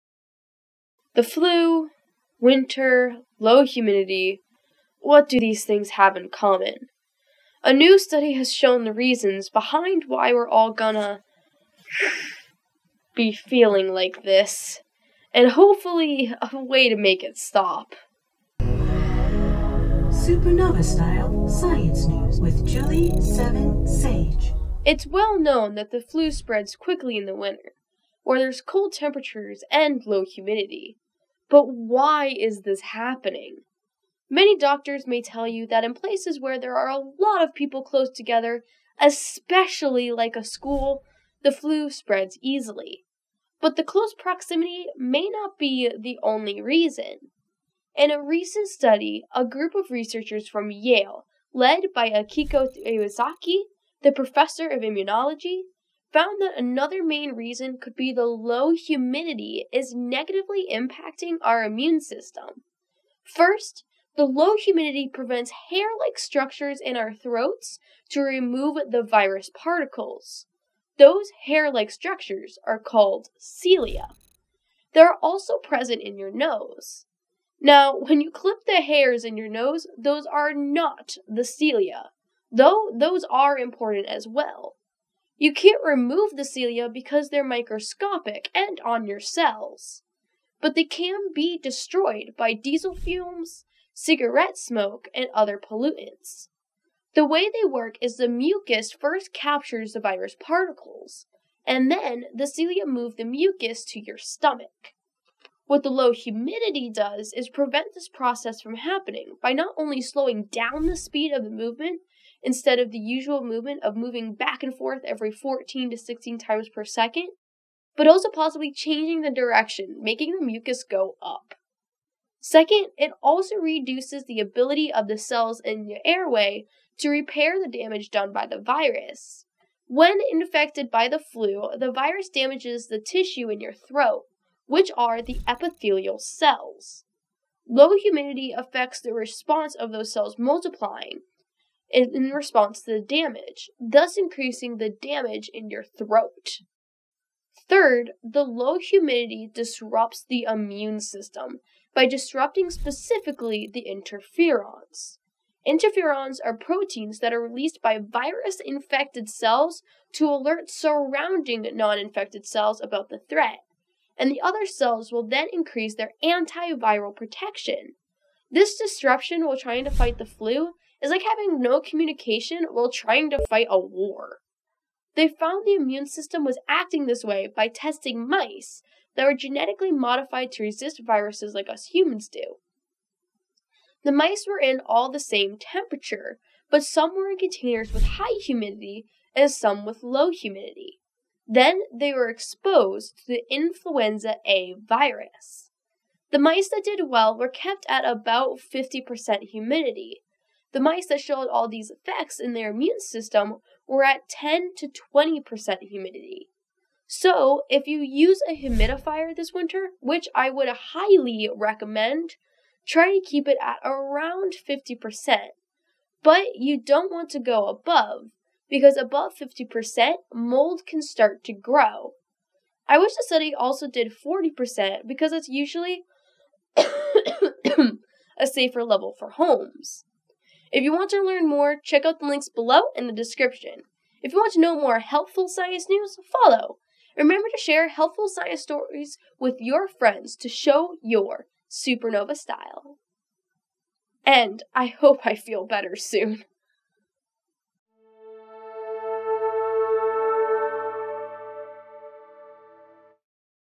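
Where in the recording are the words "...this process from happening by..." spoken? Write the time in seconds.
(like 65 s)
107 s.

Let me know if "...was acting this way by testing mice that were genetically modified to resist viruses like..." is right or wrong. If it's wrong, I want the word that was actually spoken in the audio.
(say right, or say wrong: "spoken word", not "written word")
right.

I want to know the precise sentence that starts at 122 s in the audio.
Second, it also reduces the ability of the cells in the airway to repair the damage done by the virus.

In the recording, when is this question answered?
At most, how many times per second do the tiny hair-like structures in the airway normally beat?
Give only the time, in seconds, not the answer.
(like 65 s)
115 s.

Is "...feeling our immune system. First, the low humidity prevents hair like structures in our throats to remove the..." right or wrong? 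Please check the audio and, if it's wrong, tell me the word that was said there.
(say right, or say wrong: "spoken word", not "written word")
wrong: "impacting", not "feeling".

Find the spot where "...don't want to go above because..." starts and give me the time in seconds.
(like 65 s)
216 s.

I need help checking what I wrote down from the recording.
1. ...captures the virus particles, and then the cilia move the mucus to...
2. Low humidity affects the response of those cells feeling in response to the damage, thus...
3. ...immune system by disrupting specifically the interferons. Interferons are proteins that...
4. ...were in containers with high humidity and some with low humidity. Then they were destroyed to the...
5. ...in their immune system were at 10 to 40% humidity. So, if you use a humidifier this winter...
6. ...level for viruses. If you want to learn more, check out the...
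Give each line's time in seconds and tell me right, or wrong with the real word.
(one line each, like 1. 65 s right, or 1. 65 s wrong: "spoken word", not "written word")
1. 99 s right
2. 137 s wrong: "multiplying", not "feeling"
3. 150 s right
4. 187 s wrong: "exposed", not "destroyed"
5. 202 s wrong: "20", not "40"
6. 228 s wrong: "homes", not "viruses".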